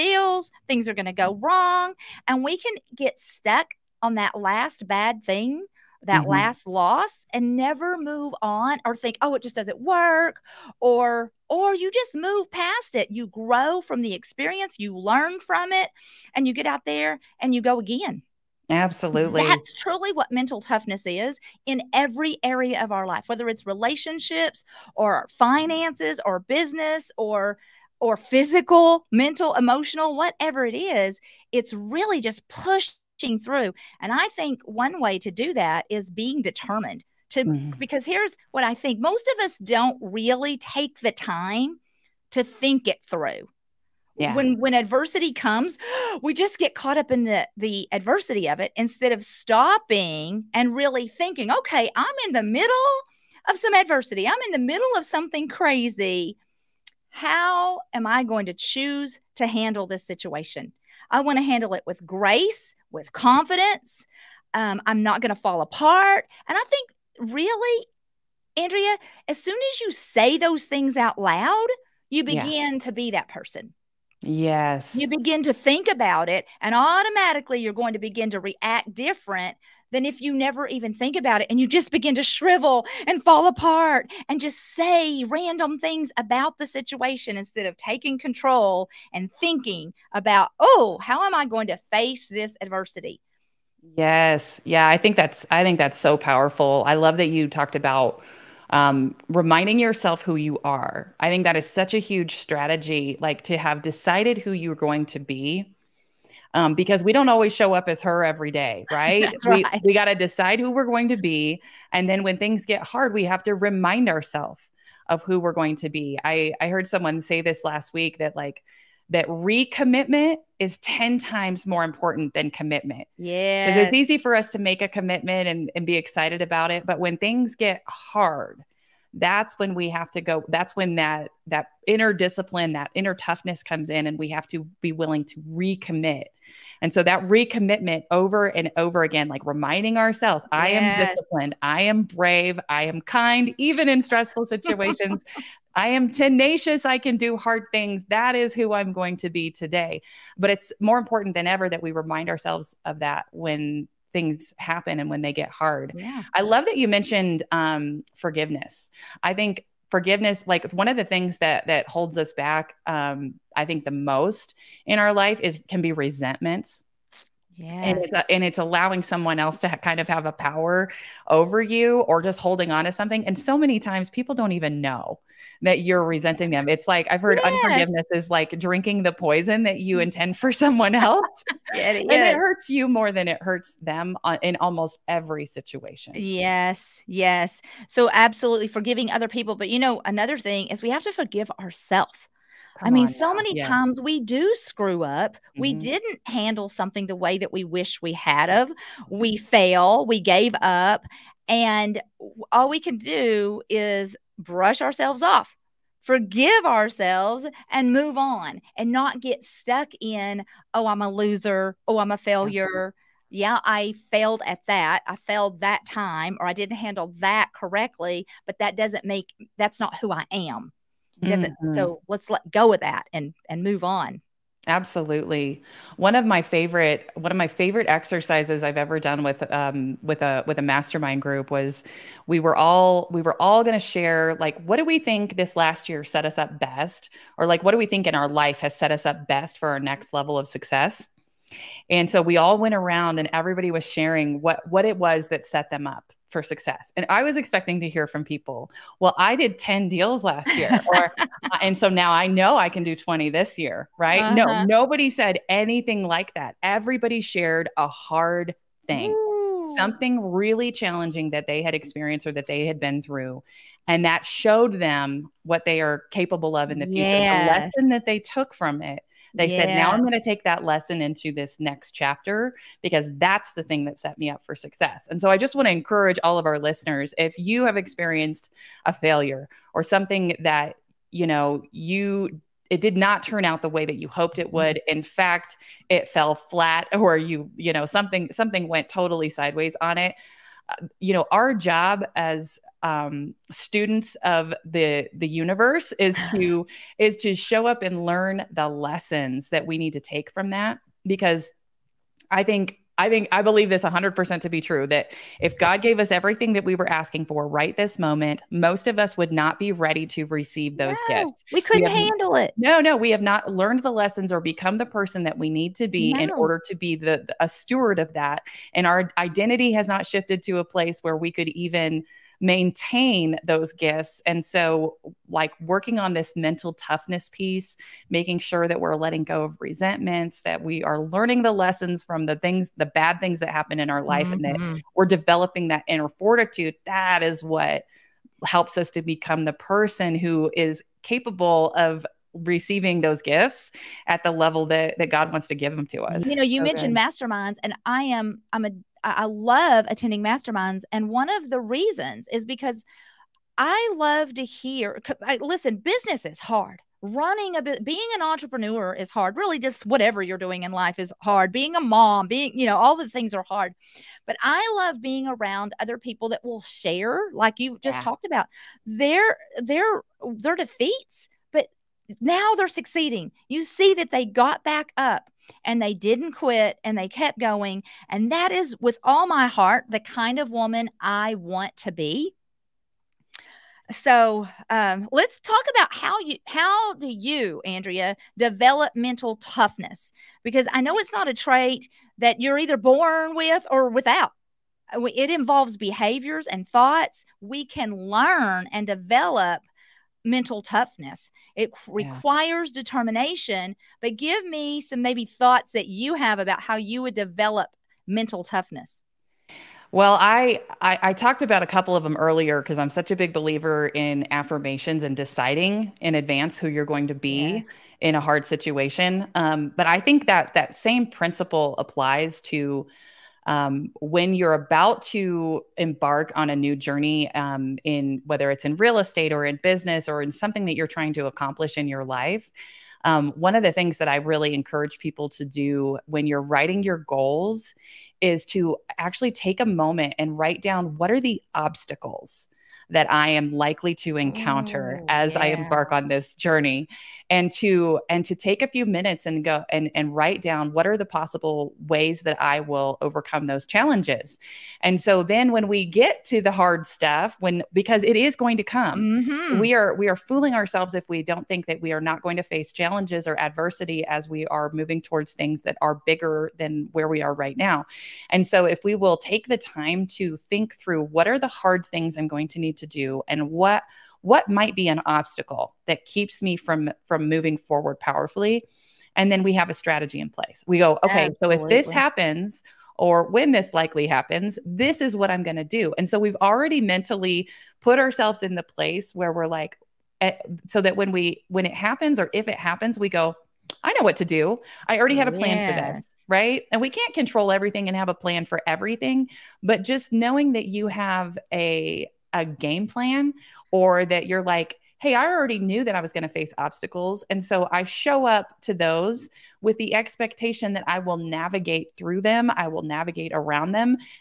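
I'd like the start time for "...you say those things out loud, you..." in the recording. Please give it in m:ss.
1:09.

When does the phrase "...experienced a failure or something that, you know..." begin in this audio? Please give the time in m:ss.
4:37.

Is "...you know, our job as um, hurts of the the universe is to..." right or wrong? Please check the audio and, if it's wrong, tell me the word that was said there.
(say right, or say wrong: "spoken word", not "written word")
wrong: "students", not "hurts".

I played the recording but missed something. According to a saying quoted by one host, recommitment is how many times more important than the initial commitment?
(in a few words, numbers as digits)
10.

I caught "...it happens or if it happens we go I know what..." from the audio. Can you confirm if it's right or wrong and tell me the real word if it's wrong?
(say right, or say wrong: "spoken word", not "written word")
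right.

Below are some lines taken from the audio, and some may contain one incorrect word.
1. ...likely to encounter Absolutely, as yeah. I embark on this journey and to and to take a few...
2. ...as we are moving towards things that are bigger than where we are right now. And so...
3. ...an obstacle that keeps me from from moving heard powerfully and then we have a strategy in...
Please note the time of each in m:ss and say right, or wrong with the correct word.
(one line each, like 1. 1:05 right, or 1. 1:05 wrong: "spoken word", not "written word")
1. 7:23 wrong: "Ooh", not "Absolutely"
2. 7:44 right
3. 7:54 wrong: "forward", not "heard".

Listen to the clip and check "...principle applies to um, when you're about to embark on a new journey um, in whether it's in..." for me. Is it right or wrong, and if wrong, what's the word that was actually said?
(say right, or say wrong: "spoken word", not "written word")
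right.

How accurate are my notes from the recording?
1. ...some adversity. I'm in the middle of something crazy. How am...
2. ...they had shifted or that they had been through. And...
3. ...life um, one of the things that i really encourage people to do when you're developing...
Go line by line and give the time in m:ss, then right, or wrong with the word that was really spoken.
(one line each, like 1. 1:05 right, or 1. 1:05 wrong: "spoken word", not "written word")
1. 0:53 right
2. 4:21 wrong: "experienced", not "shifted"
3. 7:12 wrong: "writing", not "developing".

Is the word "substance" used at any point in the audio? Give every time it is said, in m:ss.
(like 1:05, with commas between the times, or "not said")
not said.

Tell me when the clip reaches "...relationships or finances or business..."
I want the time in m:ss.
0:23.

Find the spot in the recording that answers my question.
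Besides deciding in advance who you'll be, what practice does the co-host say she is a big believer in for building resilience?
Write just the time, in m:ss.
6:54.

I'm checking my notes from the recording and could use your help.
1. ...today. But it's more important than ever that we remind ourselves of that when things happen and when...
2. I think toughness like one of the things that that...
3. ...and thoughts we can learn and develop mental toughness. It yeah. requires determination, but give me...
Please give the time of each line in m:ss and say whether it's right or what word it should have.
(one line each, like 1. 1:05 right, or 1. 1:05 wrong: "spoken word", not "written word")
1. 2:29 right
2. 2:39 wrong: "forgiveness", not "toughness"
3. 6:36 right.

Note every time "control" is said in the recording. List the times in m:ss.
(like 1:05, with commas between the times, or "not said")
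1:28, 8:17.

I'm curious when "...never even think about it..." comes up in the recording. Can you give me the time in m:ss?
1:20.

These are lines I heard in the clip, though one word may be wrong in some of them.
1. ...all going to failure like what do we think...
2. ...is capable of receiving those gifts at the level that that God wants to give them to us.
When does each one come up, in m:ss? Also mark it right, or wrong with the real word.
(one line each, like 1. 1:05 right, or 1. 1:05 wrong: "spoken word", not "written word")
1. 3:53 wrong: "share", not "failure"
2. 5:40 right.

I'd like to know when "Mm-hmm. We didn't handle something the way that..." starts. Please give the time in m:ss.
3:15.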